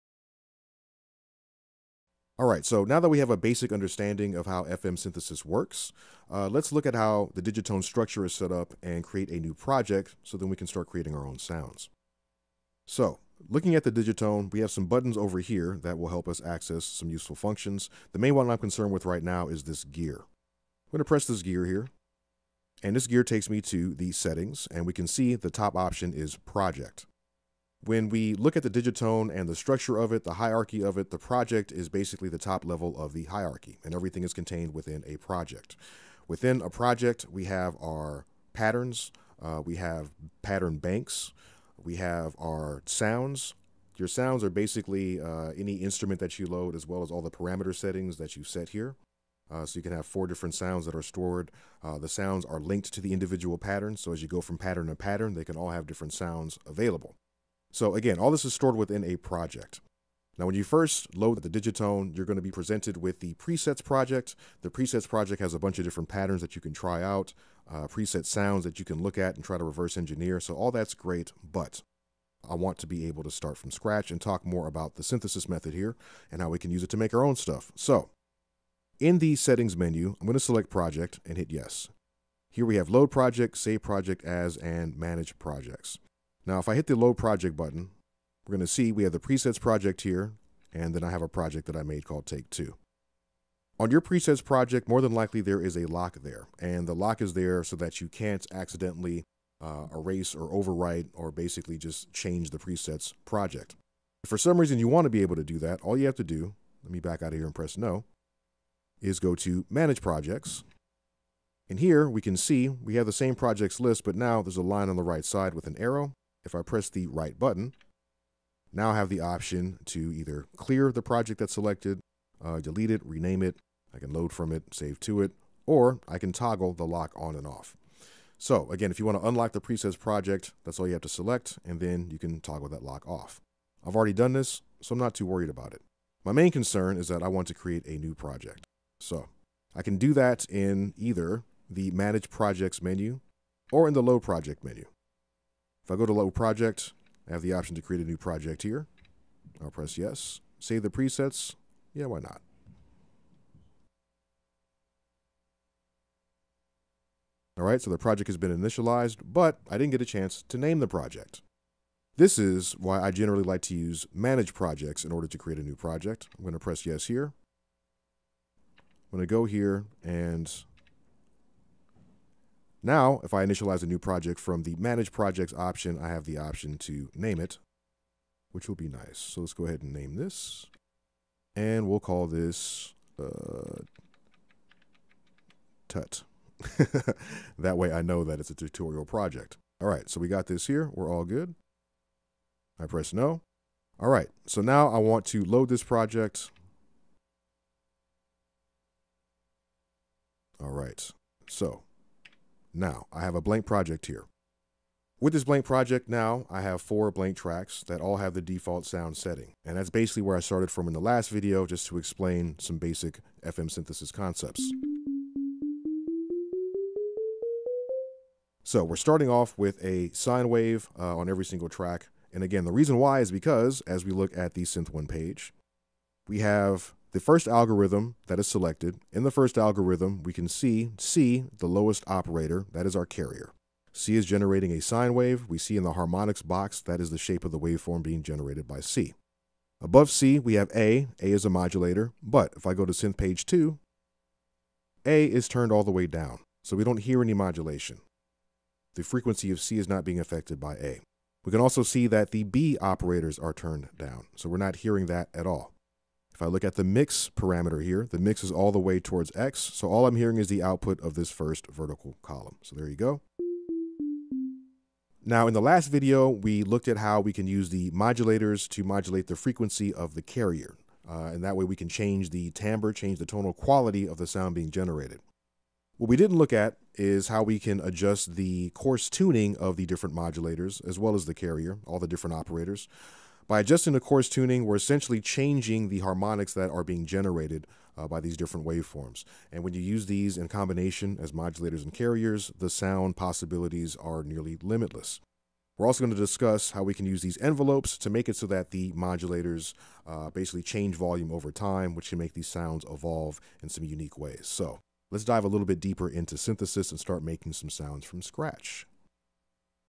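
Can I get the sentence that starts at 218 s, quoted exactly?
So we're starting off with a sine wave uh, on every single track.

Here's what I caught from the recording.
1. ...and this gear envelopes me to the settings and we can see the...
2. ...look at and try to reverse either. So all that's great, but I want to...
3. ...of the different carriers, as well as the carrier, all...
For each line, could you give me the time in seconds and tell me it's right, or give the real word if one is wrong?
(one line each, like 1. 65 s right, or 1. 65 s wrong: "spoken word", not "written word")
1. 22 s wrong: "takes", not "envelopes"
2. 69 s wrong: "engineer", not "either"
3. 279 s wrong: "modulators", not "carriers".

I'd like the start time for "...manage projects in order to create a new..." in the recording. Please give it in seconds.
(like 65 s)
164 s.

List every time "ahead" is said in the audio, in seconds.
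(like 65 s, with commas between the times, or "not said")
179 s.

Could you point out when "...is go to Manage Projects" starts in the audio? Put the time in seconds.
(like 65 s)
109 s.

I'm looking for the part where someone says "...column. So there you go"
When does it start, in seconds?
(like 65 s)
262 s.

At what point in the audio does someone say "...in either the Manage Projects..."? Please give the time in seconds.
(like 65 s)
140 s.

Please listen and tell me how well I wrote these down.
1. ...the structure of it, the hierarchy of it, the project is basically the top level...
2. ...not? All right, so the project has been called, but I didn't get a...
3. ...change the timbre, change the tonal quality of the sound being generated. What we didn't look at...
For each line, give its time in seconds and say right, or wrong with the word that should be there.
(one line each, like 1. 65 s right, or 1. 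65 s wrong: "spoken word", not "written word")
1. 29 s right
2. 152 s wrong: "initialized", not "called"
3. 271 s right.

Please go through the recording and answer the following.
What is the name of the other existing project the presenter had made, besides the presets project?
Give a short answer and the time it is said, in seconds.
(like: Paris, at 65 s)
Take 2, at 92 s.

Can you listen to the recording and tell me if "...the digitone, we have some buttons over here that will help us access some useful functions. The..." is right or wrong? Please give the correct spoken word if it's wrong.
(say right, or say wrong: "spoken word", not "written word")
right.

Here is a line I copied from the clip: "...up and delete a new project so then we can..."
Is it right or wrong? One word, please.
wrong.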